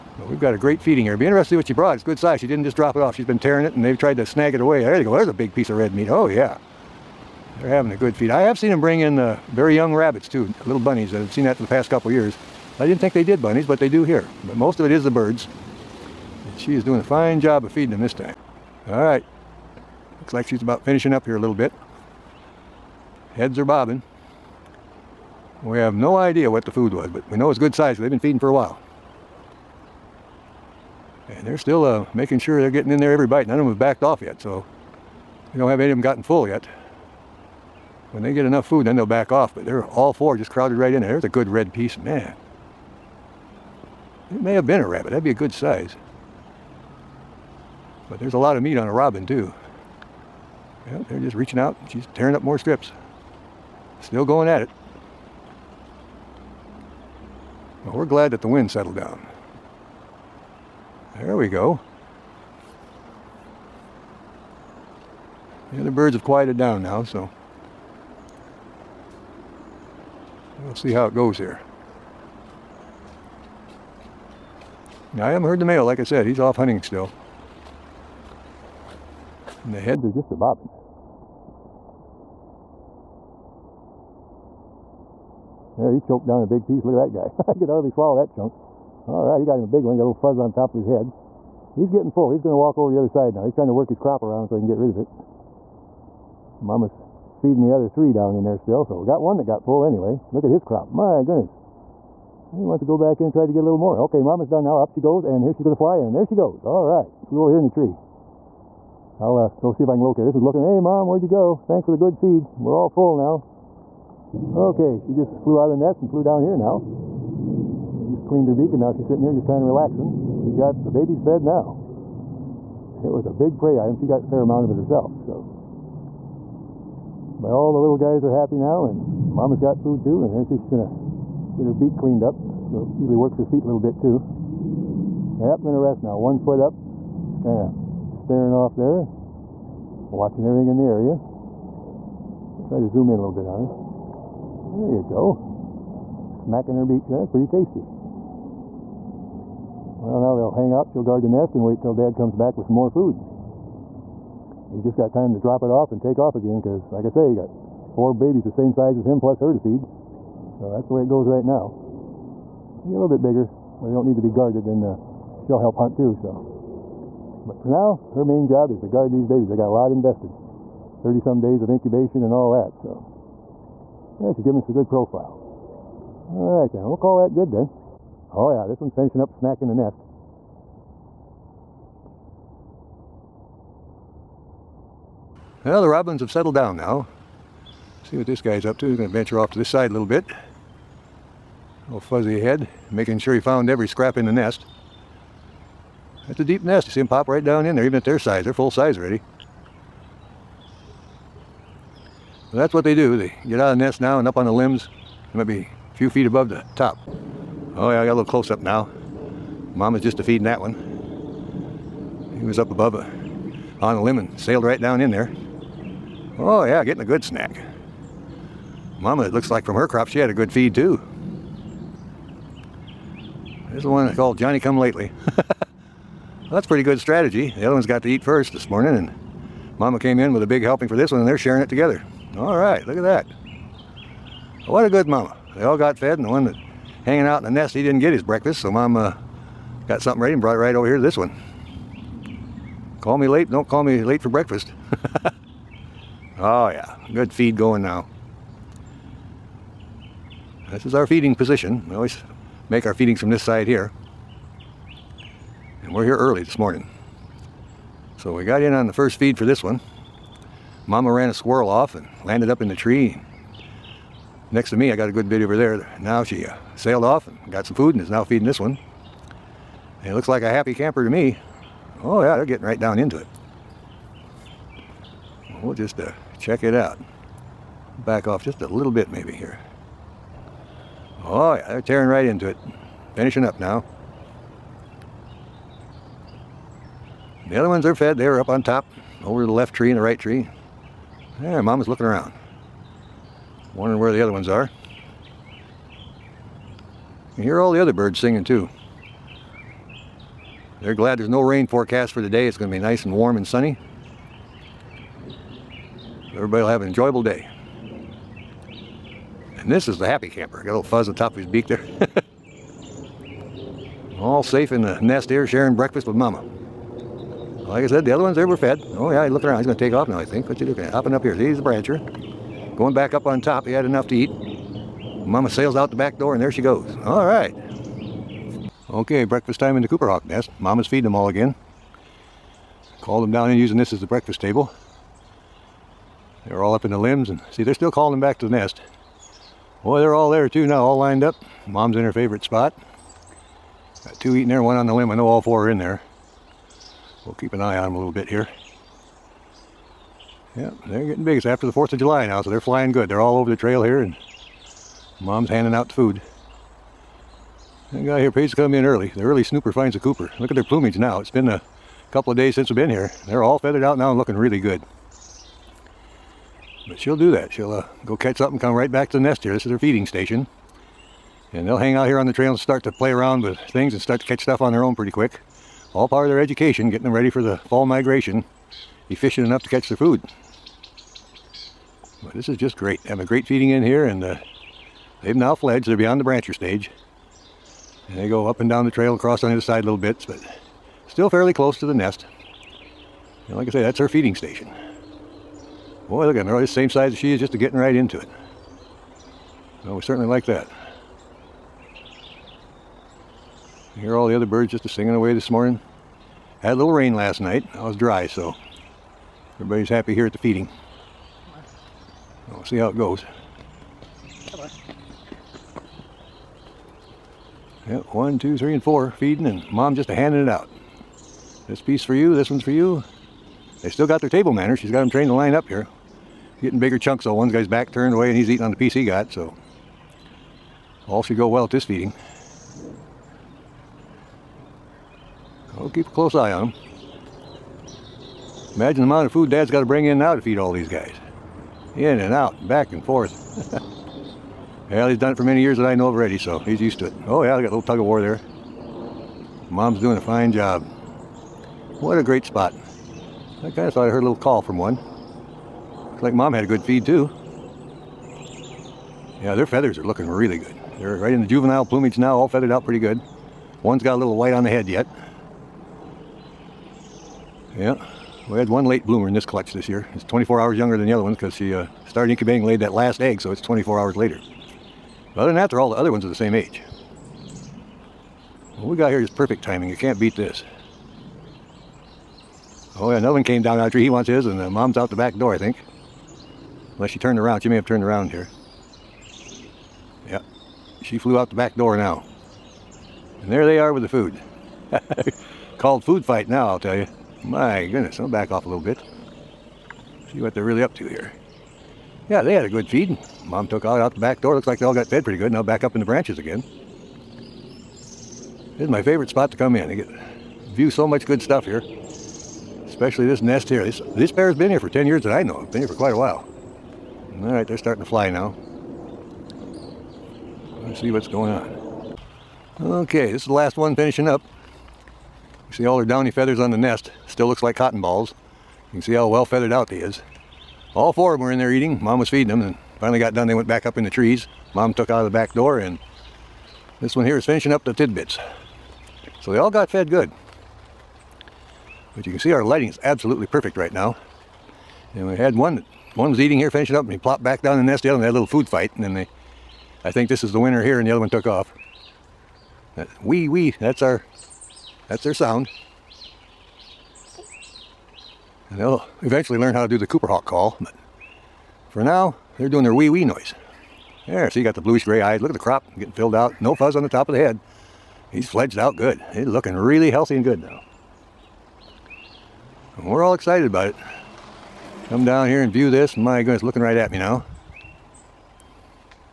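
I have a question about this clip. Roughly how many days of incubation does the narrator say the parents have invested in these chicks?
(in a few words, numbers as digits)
30 some days.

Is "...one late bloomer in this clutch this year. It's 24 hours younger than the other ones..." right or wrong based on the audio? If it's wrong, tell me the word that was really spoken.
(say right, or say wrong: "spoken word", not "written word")
right.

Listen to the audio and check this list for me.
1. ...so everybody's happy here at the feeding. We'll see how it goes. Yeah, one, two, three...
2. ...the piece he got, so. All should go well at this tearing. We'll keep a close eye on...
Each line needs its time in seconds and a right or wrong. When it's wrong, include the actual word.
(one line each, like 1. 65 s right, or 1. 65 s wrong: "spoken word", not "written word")
1. 408 s right
2. 428 s wrong: "feeding", not "tearing".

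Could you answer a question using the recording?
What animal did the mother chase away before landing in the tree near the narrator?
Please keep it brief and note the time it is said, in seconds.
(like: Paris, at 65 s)
a squirrel, at 261 s.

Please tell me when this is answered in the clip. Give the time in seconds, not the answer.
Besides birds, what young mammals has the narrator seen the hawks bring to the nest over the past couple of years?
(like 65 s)
9 s.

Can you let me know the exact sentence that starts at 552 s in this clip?
That wee wee, that's our, that's their sound.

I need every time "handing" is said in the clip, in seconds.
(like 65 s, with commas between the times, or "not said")
355 s, 420 s.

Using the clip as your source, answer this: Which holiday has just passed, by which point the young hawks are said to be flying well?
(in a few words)
4th of July.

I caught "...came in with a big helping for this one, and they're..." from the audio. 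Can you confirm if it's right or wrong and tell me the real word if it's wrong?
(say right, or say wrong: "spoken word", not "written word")
right.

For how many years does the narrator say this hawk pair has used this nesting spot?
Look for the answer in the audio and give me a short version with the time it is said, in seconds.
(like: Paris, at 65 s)
10, at 514 s.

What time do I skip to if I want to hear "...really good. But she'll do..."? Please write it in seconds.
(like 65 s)
364 s.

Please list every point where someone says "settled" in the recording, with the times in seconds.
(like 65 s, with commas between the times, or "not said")
58 s, 186 s.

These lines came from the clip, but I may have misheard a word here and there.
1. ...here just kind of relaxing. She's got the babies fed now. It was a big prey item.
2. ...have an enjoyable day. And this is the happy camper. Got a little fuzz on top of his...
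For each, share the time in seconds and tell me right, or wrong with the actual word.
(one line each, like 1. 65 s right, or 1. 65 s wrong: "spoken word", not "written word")
1. 119 s right
2. 306 s right.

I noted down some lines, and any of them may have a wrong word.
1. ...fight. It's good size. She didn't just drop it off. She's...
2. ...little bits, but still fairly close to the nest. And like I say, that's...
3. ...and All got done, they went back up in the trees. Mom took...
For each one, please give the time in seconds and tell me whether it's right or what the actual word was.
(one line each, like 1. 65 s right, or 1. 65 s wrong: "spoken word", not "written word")
1. 1 s wrong: "brought", not "fight"
2. 389 s right
3. 532 s wrong: "Finally", not "All".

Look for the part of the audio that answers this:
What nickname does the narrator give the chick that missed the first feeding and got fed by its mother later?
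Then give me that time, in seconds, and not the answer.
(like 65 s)
224 s.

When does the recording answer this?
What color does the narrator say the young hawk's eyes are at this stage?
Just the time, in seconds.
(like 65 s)
564 s.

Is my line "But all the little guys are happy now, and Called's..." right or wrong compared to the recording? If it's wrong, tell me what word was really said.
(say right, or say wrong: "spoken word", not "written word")
wrong: "Mama", not "Called".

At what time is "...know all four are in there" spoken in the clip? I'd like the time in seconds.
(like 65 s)
345 s.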